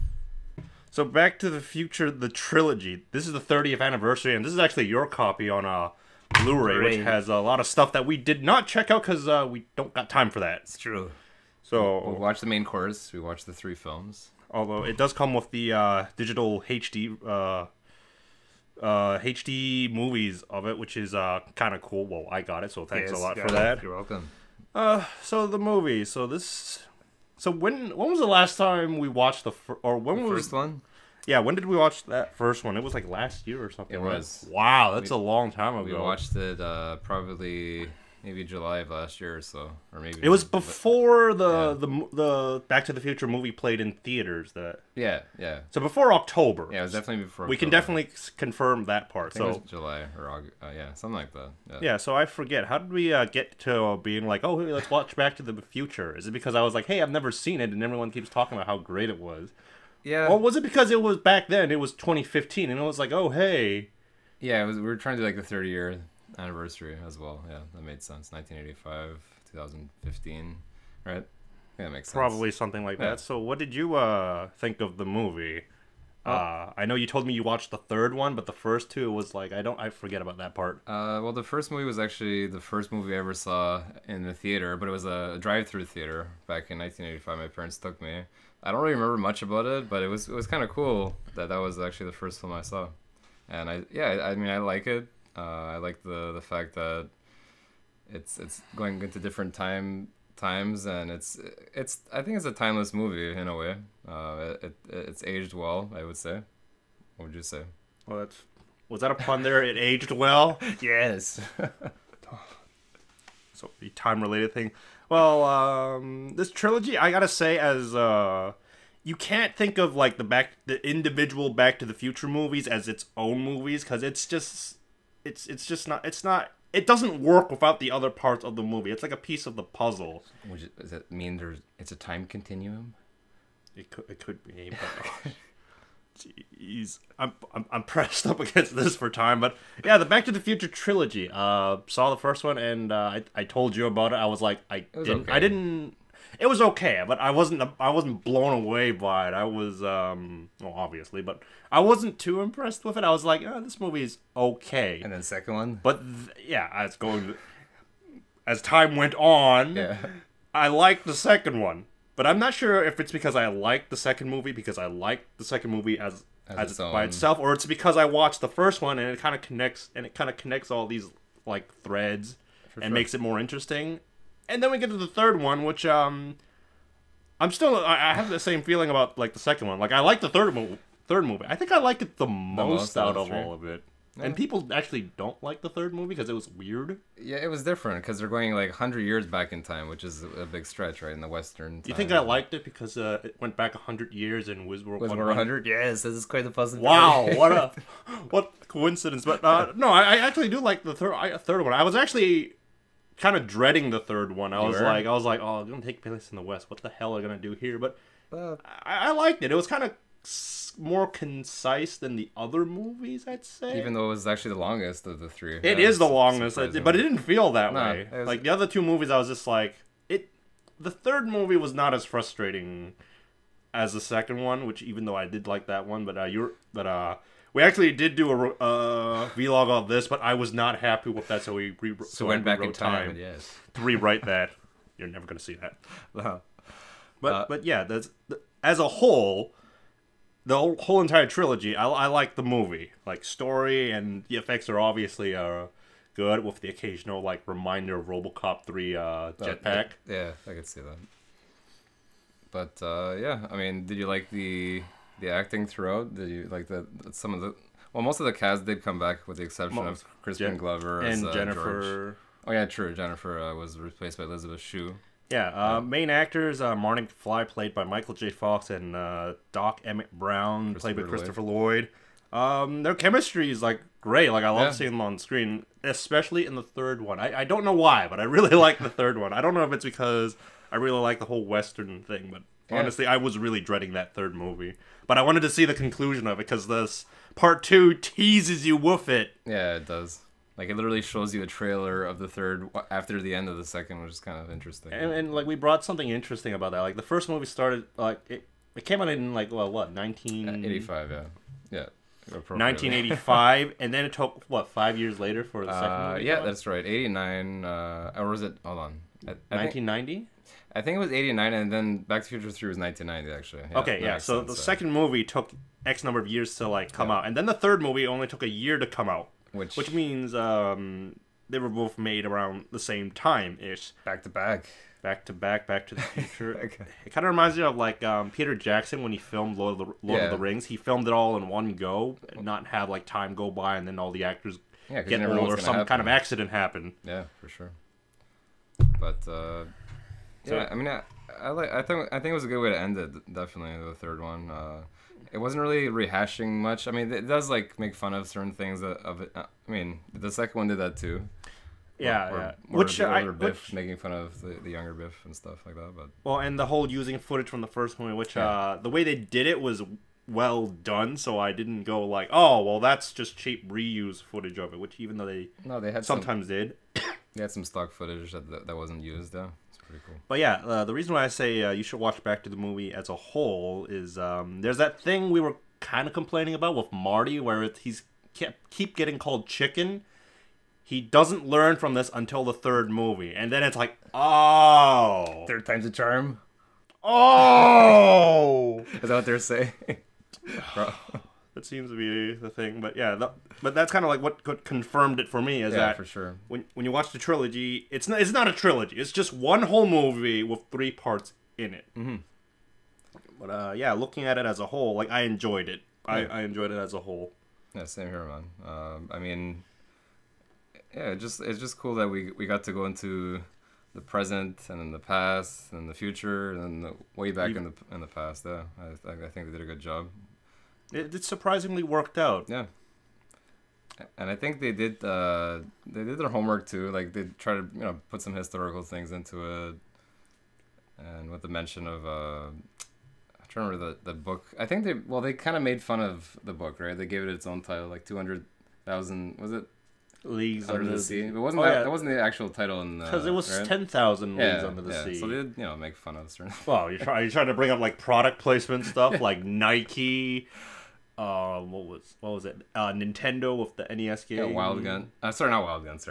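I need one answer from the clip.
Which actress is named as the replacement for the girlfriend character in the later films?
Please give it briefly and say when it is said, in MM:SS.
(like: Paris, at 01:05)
Elizabeth Shue, at 04:24.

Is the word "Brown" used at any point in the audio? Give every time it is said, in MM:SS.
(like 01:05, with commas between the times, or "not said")
04:30.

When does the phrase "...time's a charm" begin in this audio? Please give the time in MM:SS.
06:25.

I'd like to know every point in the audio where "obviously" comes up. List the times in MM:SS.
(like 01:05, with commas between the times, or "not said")
02:30, 04:04.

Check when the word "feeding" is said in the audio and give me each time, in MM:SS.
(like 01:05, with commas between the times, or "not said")
not said.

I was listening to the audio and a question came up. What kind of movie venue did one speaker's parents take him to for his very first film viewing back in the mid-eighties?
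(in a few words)
drive-through theater.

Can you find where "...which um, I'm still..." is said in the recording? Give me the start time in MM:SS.
02:55.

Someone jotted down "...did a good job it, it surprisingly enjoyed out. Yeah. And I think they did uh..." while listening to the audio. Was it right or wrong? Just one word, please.
wrong.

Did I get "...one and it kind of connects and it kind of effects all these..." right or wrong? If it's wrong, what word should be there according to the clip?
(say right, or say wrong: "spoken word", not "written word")
wrong: "connects", not "effects".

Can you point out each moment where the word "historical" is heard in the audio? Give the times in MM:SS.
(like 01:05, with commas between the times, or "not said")
07:08.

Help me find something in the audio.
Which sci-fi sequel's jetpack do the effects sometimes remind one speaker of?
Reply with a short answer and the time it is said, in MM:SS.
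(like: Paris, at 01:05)
RoboCop 3, at 04:08.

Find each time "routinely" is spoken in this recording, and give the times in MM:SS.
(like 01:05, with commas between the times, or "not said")
not said.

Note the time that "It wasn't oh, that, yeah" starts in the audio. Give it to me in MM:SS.
07:21.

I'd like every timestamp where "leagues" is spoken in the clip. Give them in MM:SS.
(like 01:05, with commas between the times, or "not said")
07:20, 07:24.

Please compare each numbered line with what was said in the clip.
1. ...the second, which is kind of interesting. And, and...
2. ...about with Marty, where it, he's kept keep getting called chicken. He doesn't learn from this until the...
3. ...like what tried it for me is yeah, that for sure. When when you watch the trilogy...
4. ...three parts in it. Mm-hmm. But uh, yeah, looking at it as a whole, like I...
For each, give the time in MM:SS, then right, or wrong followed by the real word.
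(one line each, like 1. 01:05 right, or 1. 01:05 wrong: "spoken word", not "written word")
1. 04:53 right
2. 06:16 right
3. 06:34 wrong: "confirmed", not "tried"
4. 06:40 right.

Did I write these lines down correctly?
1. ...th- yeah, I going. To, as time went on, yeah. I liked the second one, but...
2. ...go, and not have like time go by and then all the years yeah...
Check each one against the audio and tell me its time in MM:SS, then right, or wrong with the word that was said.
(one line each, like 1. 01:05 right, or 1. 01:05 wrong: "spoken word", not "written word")
1. 02:36 right
2. 05:31 wrong: "actors", not "years".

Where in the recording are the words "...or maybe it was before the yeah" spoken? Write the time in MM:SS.
00:39.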